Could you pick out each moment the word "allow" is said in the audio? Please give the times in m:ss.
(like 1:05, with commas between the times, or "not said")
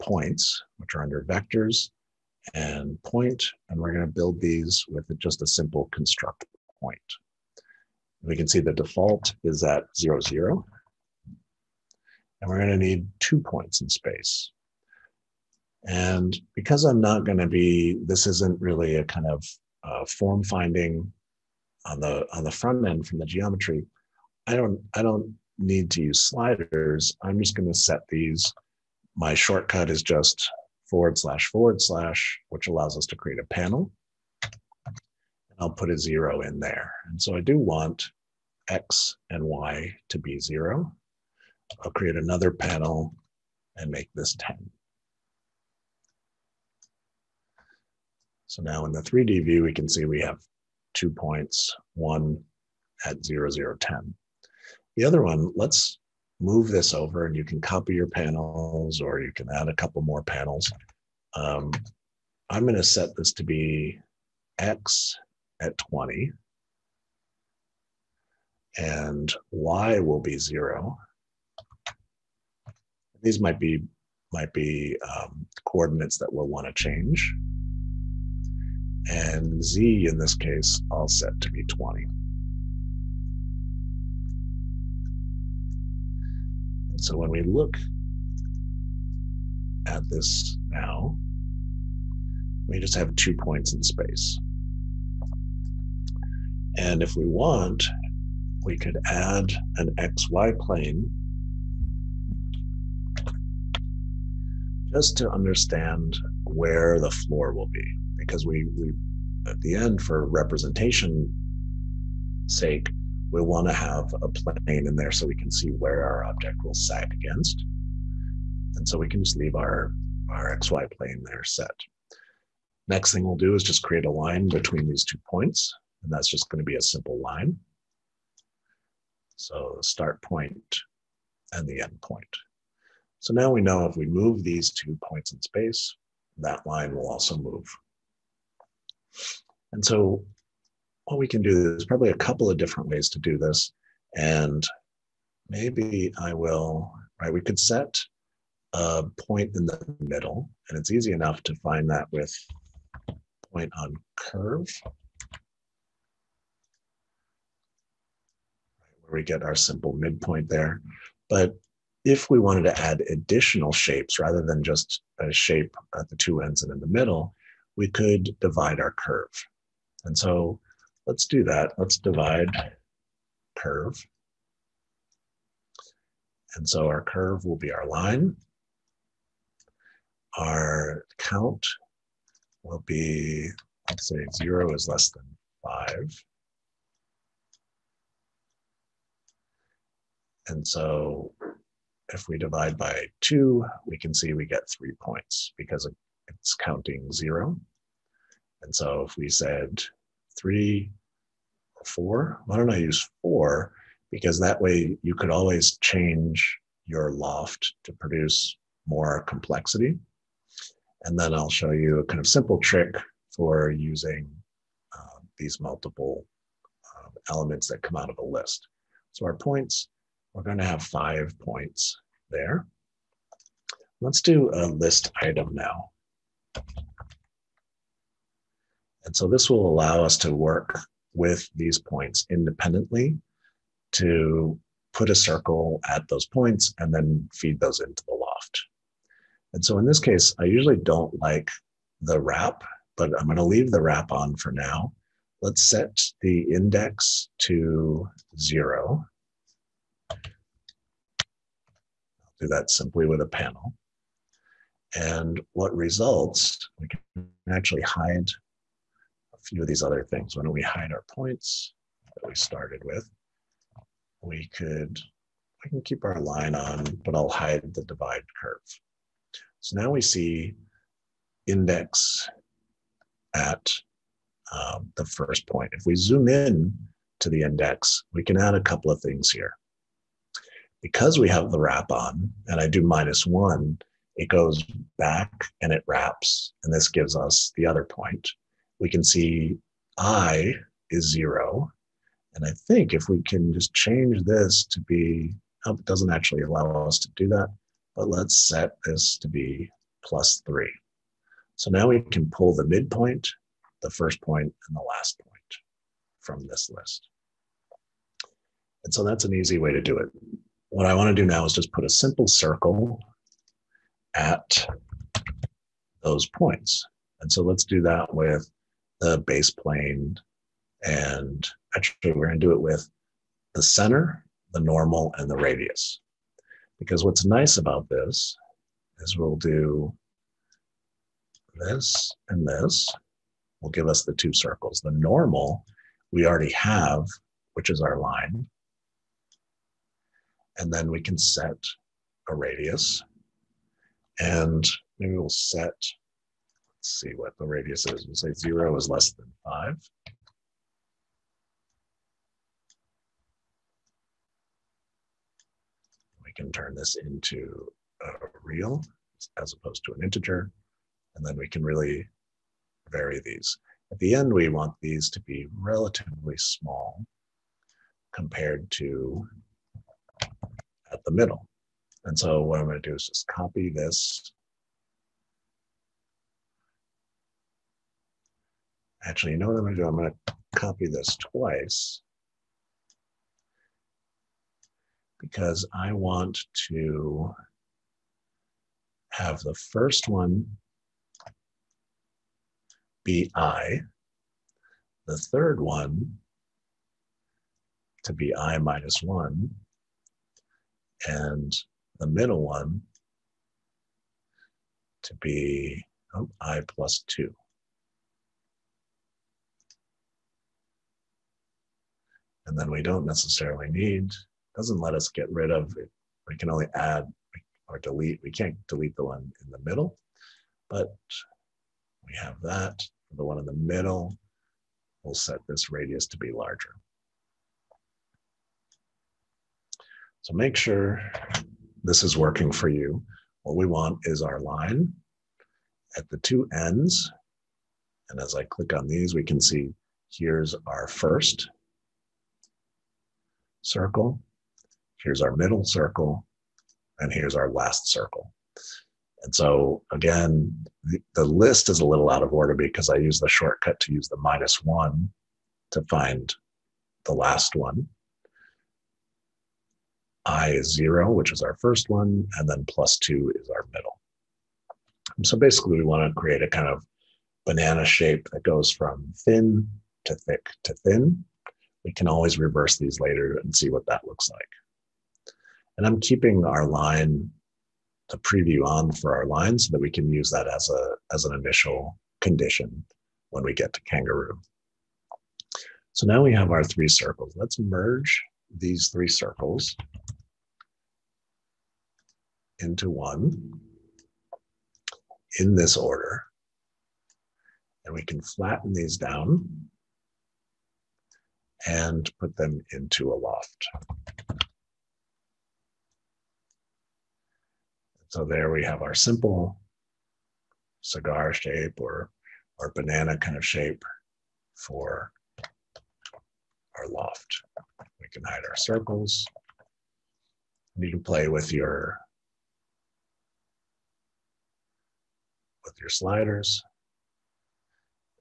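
0:32, 3:49, 4:56.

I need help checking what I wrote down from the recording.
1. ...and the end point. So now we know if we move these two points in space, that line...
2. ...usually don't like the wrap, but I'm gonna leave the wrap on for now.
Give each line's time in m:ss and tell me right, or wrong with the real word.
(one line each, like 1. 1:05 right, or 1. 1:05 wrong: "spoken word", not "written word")
1. 2:11 right
2. 4:00 right.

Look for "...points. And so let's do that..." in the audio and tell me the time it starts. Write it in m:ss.
5:16.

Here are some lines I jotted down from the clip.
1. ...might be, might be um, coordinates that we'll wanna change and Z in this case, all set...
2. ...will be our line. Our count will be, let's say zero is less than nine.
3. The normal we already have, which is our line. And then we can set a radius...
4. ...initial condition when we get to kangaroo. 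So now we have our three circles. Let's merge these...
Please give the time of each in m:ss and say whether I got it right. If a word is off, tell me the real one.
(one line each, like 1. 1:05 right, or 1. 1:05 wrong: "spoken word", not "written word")
1. 1:13 right
2. 2:57 wrong: "five", not "nine"
3. 5:34 right
4. 8:01 right.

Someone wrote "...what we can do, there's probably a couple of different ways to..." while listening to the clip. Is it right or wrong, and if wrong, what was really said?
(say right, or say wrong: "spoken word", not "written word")
right.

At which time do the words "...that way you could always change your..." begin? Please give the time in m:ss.
3:24.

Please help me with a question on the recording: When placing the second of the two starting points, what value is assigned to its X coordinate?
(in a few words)
20.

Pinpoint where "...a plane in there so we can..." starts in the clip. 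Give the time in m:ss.
1:54.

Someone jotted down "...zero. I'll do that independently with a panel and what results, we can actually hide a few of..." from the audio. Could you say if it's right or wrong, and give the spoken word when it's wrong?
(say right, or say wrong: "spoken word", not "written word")
wrong: "simply", not "independently".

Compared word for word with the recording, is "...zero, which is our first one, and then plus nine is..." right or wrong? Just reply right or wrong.
wrong.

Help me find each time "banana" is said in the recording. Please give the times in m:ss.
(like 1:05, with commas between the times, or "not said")
7:47, 8:32.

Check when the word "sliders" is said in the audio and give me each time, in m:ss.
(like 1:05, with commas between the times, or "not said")
0:26, 8:45.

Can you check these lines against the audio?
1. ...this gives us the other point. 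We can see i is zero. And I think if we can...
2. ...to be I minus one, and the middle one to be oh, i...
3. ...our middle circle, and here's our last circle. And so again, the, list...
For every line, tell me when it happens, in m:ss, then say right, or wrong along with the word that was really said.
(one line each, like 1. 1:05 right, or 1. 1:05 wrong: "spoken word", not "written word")
1. 4:46 right
2. 6:38 right
3. 7:25 right.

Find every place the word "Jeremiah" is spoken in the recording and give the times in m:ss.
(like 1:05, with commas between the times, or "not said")
not said.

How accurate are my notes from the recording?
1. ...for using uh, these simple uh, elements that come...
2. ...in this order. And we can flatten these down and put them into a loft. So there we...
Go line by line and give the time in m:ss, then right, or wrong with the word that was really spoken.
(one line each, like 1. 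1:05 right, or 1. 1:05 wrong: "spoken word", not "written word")
1. 3:33 wrong: "multiple", not "simple"
2. 8:15 right.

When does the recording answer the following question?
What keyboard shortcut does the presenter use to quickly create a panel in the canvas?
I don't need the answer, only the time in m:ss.
0:30.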